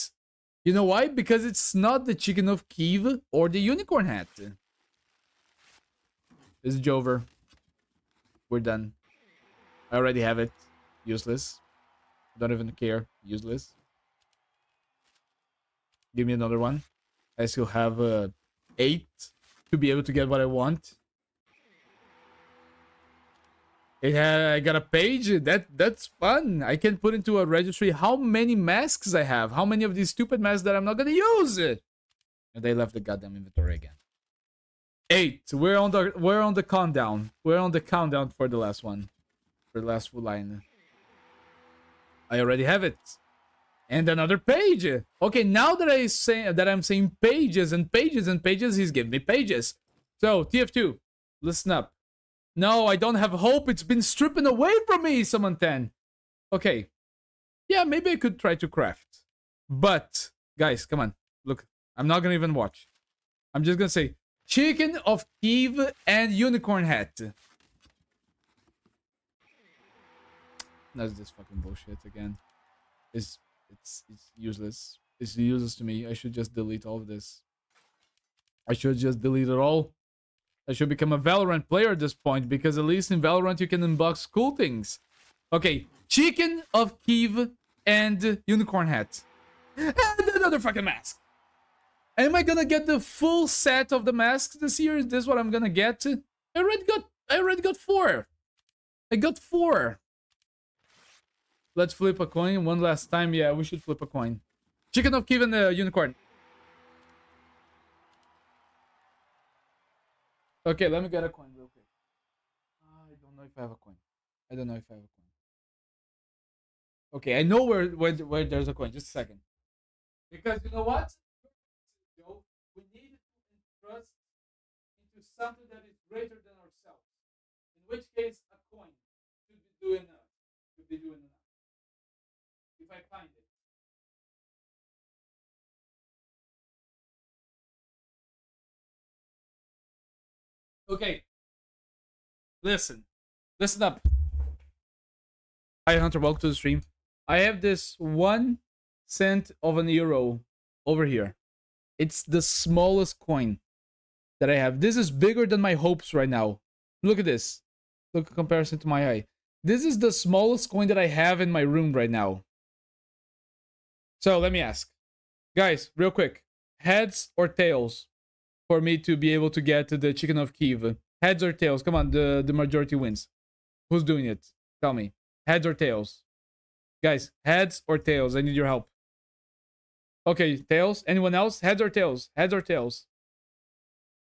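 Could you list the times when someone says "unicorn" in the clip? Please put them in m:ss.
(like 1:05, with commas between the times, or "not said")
0:03, 1:06, 1:28, 1:45.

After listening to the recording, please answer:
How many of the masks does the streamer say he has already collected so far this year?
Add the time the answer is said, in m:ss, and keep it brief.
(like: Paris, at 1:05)
4, at 1:39.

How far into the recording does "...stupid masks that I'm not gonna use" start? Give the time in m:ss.
0:30.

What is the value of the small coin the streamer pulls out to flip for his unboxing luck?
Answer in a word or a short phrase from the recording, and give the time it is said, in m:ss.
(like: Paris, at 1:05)
1 euro cent, at 2:27.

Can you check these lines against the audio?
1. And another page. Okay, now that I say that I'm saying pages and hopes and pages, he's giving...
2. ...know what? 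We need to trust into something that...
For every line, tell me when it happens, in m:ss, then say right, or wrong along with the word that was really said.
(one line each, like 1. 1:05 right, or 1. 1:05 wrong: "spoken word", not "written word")
1. 0:43 wrong: "pages", not "hopes"
2. 2:00 right.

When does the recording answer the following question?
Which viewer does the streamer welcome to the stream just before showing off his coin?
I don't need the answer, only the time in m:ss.
2:25.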